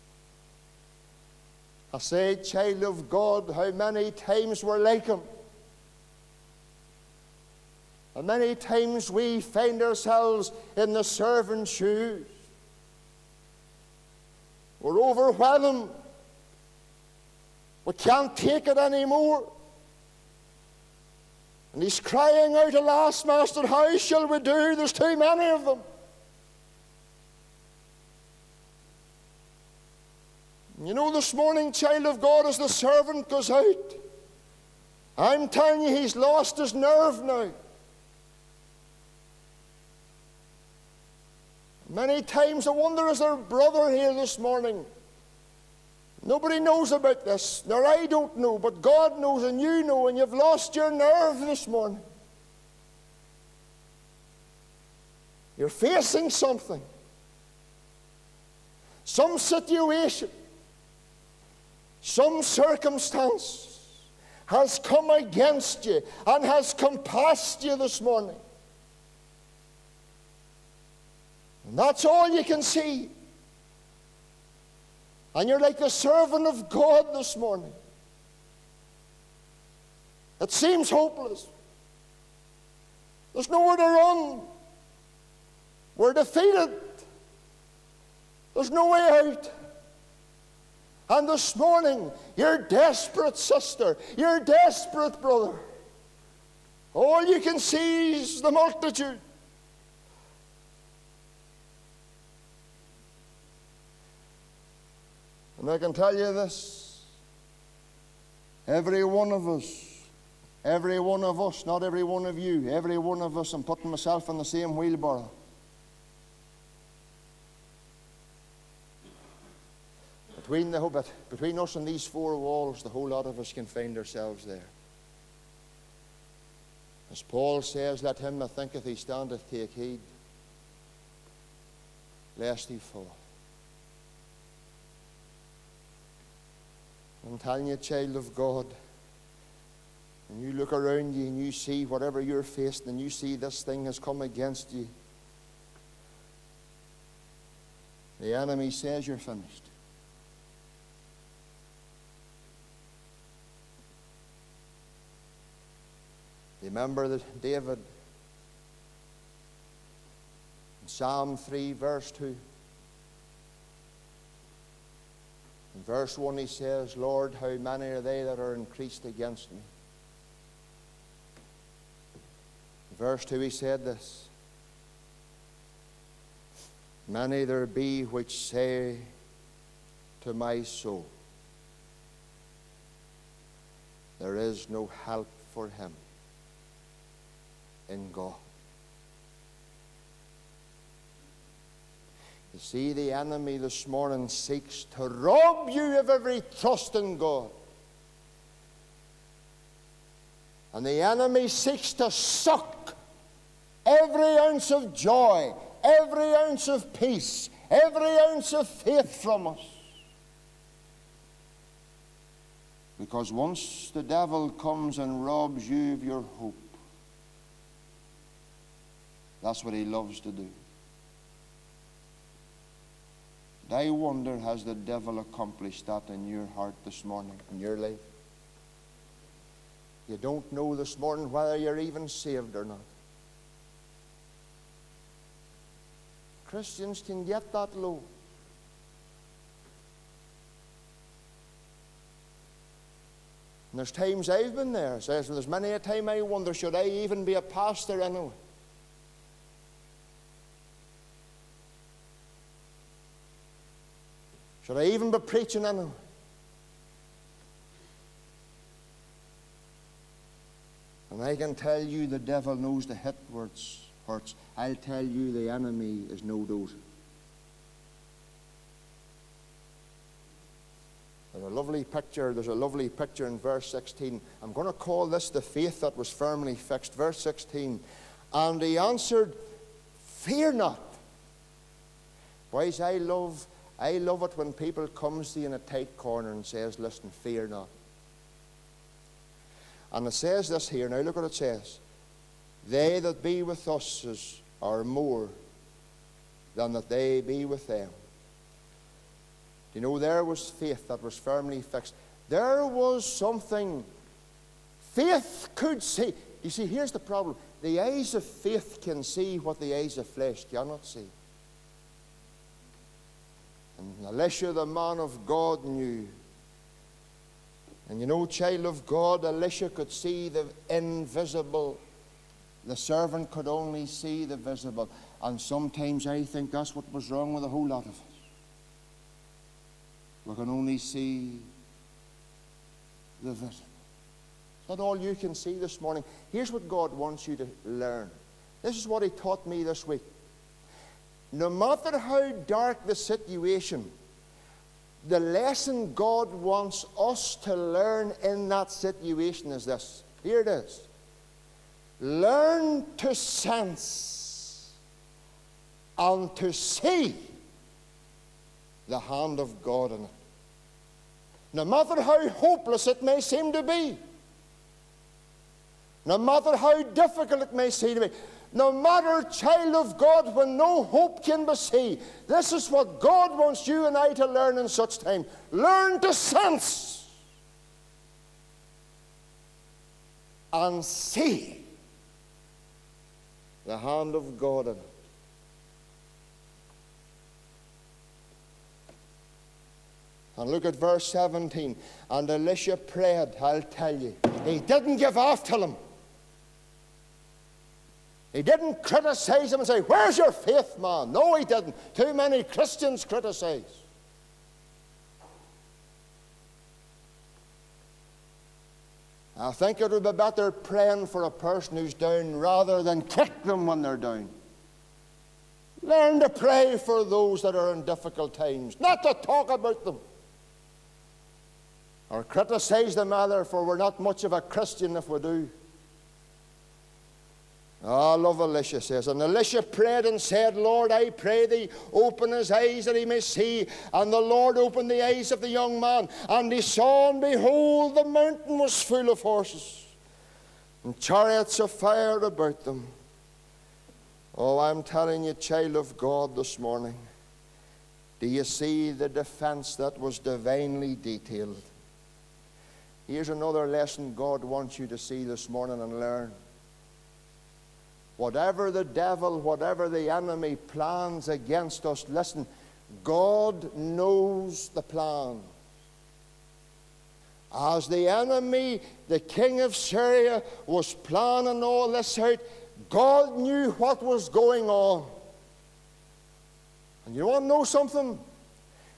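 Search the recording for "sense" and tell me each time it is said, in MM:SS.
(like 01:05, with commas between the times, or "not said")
05:53, 06:16.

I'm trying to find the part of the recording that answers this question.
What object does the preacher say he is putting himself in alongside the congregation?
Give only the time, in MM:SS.
01:54.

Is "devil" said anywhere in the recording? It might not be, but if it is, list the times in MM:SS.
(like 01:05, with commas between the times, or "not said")
03:34, 03:44, 04:22, 07:38.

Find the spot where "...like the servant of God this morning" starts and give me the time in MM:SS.
01:15.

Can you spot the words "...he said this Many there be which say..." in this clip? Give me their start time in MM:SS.
02:53.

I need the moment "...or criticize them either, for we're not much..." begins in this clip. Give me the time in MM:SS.
07:02.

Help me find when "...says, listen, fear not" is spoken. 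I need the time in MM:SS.
04:46.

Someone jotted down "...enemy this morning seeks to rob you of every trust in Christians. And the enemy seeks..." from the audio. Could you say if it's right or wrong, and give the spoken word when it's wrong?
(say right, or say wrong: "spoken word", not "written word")
wrong: "God", not "Christians".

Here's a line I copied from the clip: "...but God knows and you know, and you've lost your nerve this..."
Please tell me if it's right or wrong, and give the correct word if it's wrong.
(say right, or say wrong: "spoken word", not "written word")
right.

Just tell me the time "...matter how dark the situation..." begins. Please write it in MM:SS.
05:41.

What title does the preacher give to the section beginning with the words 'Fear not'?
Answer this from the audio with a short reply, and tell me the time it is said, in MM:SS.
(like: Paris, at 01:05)
The faith that was firmly fixed, at 04:35.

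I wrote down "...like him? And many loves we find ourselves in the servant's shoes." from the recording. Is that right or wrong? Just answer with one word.
wrong.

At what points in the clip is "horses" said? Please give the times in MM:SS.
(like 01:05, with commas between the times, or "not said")
07:19.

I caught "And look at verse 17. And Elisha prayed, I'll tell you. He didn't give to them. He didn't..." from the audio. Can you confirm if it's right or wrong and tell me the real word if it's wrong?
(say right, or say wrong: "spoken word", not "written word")
right.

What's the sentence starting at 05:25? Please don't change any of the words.
And sometimes I think that's what was wrong with a whole lot of us.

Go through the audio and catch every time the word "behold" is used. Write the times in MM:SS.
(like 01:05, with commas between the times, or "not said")
07:17.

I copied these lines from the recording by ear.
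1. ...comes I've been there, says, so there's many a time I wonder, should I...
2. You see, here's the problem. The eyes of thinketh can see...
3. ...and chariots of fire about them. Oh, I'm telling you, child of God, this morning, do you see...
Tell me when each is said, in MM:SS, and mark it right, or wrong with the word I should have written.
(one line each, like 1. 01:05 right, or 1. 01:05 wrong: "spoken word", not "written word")
1. 04:03 wrong: "times", not "comes"
2. 05:06 wrong: "faith", not "thinketh"
3. 07:20 right.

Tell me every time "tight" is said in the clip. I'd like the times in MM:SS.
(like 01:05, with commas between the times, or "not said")
04:45.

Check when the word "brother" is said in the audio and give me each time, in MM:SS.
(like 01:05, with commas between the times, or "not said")
00:43, 01:35.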